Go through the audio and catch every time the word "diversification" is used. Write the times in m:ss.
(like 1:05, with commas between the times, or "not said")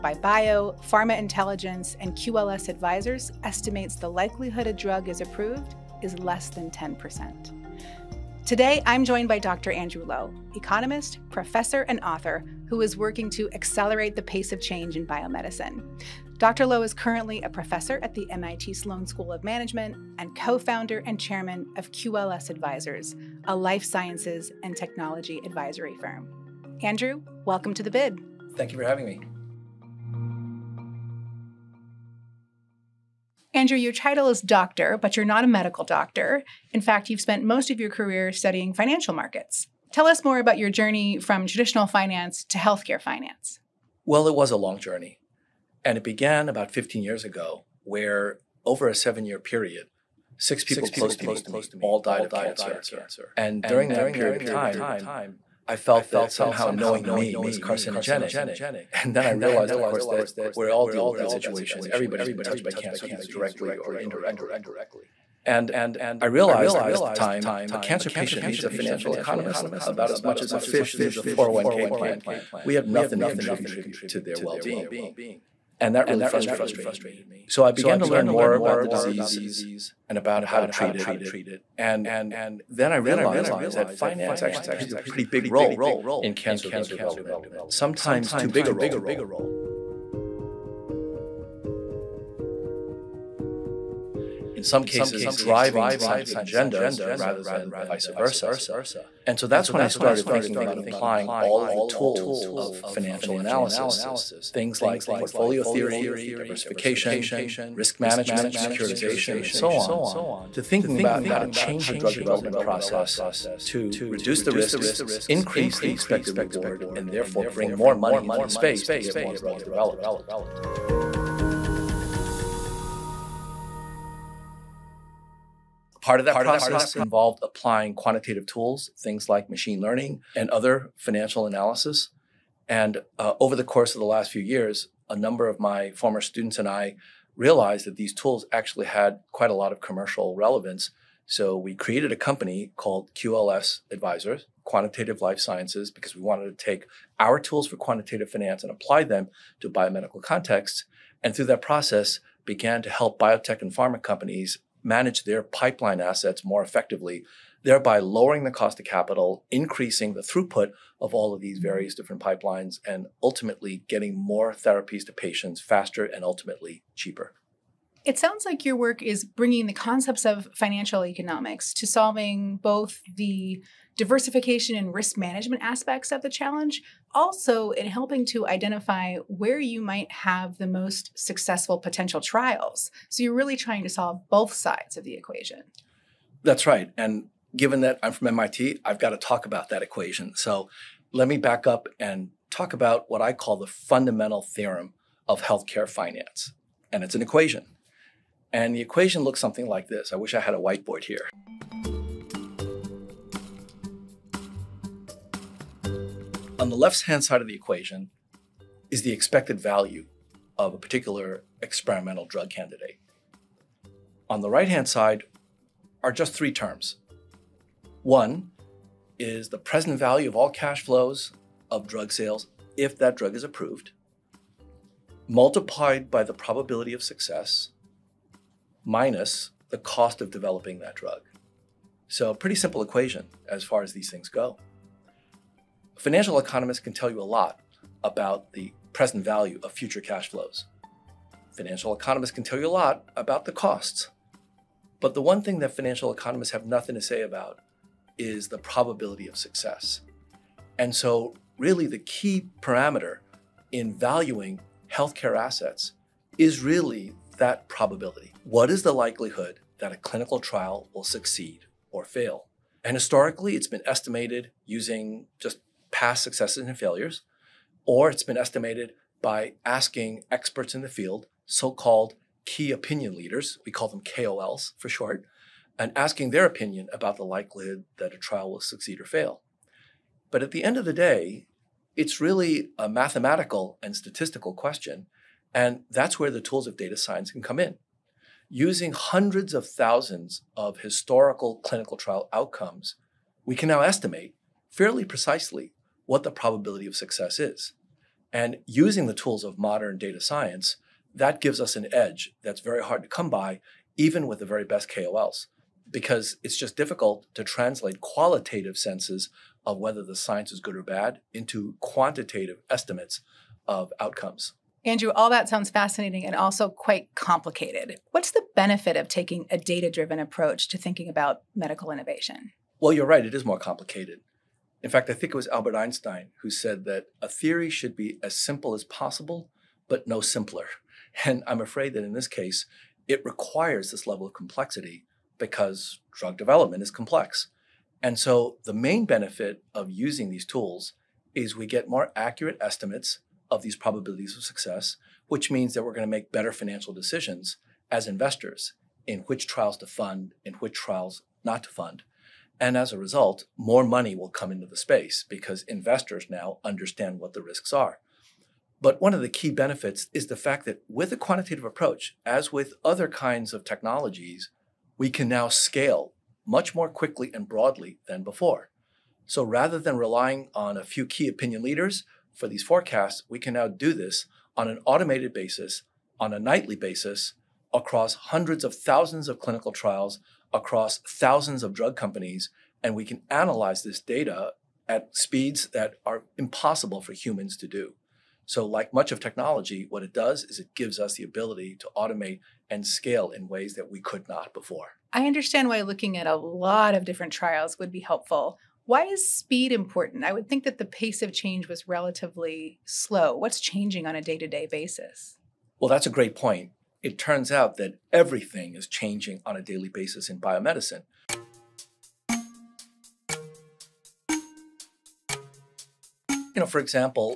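1:46, 2:53.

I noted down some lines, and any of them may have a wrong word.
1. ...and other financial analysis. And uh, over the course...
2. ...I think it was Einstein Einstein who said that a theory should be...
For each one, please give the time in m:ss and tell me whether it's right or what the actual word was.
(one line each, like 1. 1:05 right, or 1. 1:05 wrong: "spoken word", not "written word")
1. 2:10 right
2. 5:25 wrong: "Albert", not "Einstein".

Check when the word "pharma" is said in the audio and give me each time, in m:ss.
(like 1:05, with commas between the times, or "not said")
0:00, 2:33.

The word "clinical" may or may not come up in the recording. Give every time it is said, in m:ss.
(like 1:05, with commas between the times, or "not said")
4:19, 4:51, 6:19.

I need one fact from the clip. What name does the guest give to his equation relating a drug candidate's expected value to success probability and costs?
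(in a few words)
fundamental theorem of healthcare finance.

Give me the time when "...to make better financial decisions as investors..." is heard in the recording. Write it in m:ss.
5:46.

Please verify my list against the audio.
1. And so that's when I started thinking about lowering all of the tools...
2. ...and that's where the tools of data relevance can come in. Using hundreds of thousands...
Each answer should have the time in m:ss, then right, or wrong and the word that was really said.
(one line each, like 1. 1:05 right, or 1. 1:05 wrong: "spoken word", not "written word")
1. 1:39 wrong: "applying", not "lowering"
2. 4:45 wrong: "science", not "relevance".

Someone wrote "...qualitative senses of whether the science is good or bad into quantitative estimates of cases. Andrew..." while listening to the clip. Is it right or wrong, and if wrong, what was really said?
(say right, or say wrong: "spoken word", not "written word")
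wrong: "outcomes", not "cases".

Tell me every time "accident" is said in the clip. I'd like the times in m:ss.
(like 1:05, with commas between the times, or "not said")
not said.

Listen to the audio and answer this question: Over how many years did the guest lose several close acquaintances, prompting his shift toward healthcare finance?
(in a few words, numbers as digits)
7.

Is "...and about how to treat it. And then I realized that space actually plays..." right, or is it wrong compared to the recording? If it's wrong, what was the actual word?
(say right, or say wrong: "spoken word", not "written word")
wrong: "finance", not "space".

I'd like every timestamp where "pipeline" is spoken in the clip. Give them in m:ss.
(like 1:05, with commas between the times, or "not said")
2:35, 2:42.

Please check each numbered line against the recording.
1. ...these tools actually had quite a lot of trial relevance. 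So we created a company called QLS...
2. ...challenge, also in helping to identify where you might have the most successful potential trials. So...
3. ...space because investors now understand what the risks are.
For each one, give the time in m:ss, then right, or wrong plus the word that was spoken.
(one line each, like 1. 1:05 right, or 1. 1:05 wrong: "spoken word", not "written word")
1. 2:17 wrong: "commercial", not "trial"
2. 2:56 right
3. 5:54 right.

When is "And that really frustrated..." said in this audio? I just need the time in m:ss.
1:15.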